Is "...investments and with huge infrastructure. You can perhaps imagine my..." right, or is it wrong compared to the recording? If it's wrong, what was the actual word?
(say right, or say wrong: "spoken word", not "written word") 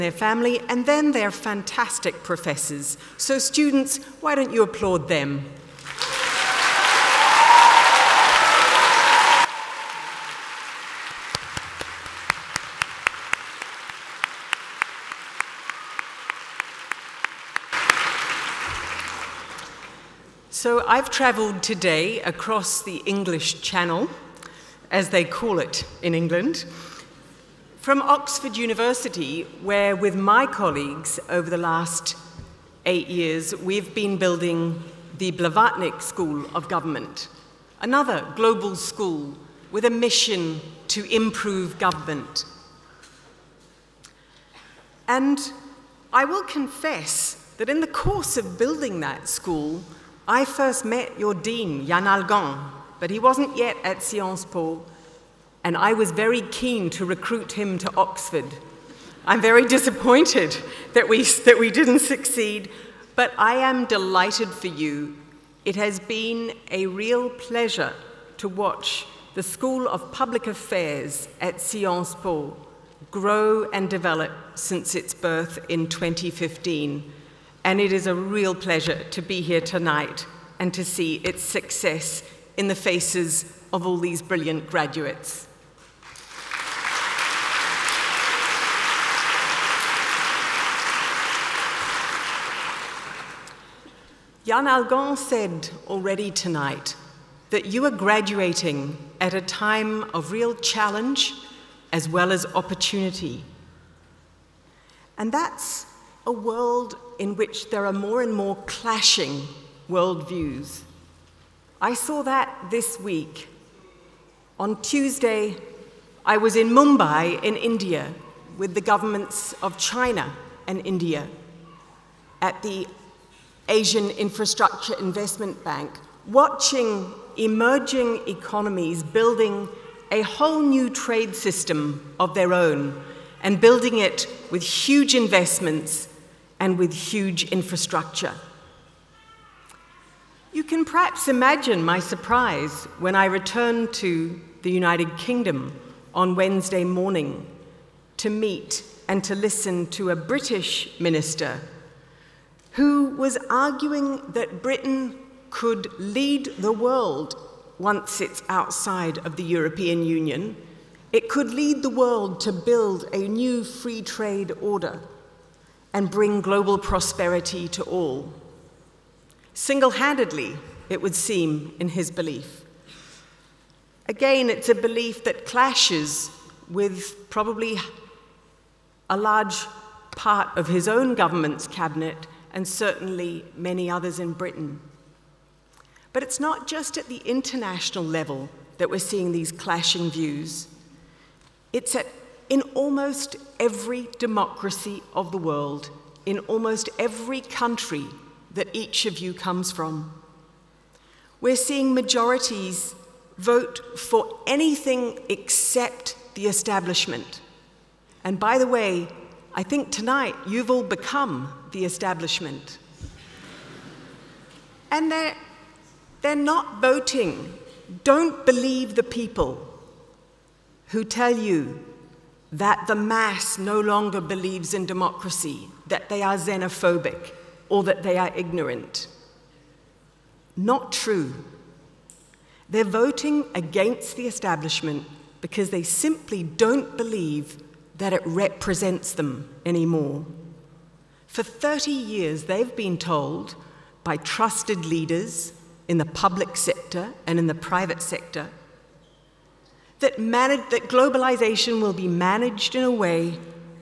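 right.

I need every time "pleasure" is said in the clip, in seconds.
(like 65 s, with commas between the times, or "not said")
67 s, 78 s.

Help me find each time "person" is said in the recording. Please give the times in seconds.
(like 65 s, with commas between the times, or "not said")
not said.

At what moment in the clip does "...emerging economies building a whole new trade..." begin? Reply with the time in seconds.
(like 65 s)
127 s.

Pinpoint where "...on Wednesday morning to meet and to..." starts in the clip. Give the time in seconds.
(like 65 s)
146 s.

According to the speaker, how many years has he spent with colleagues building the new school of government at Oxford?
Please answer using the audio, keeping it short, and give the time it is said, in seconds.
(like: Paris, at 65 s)
8, at 32 s.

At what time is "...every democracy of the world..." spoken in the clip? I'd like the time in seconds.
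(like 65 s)
193 s.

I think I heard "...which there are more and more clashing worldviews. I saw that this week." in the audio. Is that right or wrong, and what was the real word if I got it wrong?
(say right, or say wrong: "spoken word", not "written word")
right.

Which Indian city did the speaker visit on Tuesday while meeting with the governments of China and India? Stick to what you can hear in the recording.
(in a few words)
Mumbai.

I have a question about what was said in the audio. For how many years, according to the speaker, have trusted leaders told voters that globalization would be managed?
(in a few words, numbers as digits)
30.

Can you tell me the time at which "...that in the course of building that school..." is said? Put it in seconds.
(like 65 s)
47 s.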